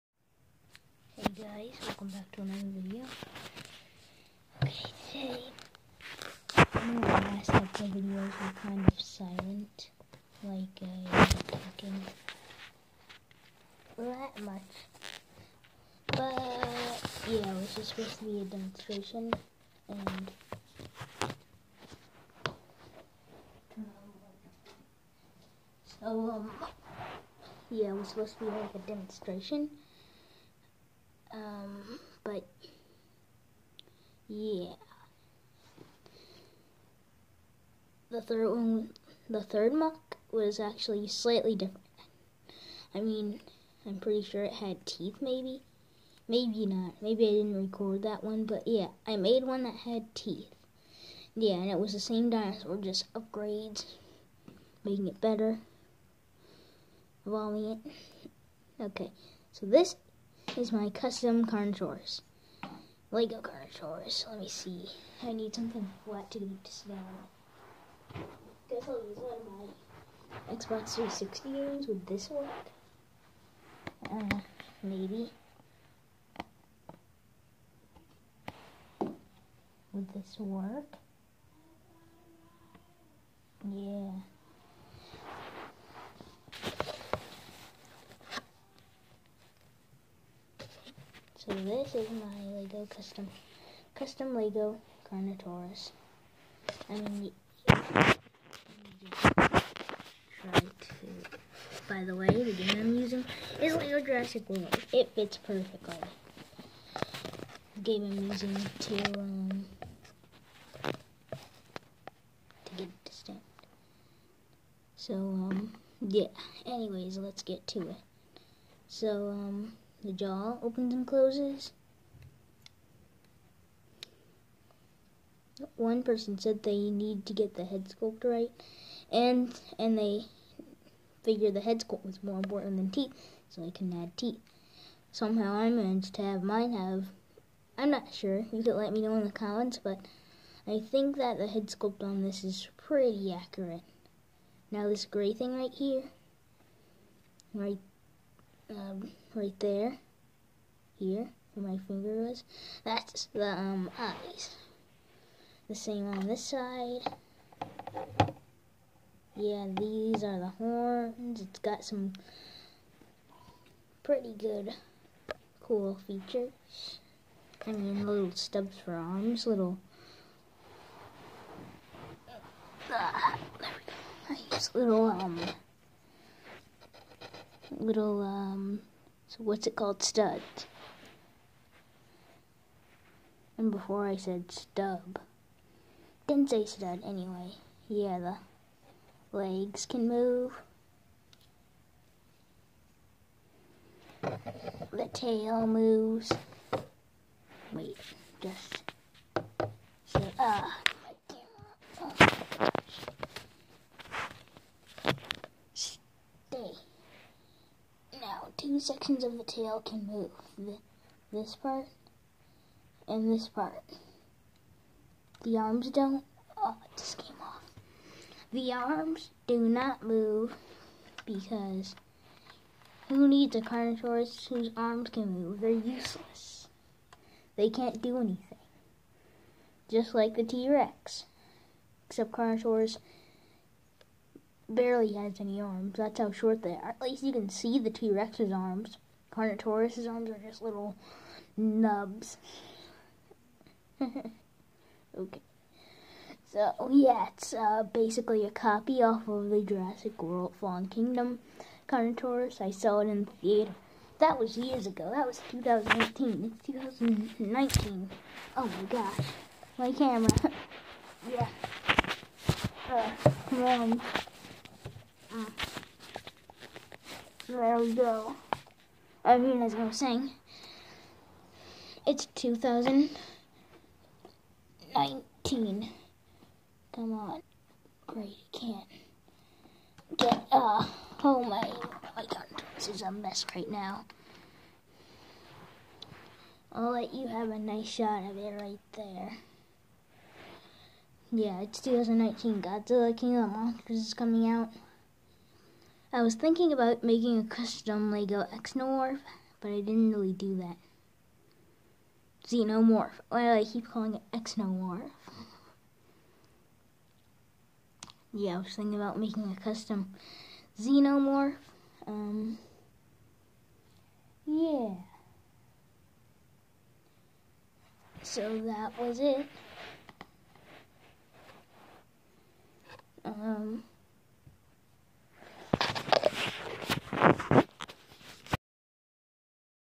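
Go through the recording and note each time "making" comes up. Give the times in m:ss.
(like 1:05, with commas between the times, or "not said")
0:54, 4:57, 5:09.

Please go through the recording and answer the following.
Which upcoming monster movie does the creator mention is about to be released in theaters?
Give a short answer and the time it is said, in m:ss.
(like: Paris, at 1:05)
Godzilla King of the Monsters, at 4:52.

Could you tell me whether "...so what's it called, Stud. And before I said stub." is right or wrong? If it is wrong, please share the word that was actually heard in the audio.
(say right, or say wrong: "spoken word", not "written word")
right.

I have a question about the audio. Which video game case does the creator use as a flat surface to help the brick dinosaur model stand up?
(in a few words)
Lego Jurassic World.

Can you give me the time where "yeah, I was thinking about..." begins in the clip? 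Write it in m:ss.
5:08.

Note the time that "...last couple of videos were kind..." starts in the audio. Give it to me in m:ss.
0:07.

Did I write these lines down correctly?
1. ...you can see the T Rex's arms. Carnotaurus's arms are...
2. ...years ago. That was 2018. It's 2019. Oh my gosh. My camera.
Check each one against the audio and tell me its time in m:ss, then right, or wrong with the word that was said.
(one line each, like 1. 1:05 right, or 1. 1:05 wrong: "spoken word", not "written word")
1. 3:57 right
2. 4:14 right.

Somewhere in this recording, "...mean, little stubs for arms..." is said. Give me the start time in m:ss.
2:47.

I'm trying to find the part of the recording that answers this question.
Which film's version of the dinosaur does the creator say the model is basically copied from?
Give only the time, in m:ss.
4:09.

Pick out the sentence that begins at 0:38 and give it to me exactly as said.
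The third one, the third MOC was actually slightly different.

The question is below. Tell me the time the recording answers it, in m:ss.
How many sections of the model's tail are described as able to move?
3:28.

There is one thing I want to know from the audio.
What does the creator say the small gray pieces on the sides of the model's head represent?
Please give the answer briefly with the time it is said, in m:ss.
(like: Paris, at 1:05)
eyes, at 2:33.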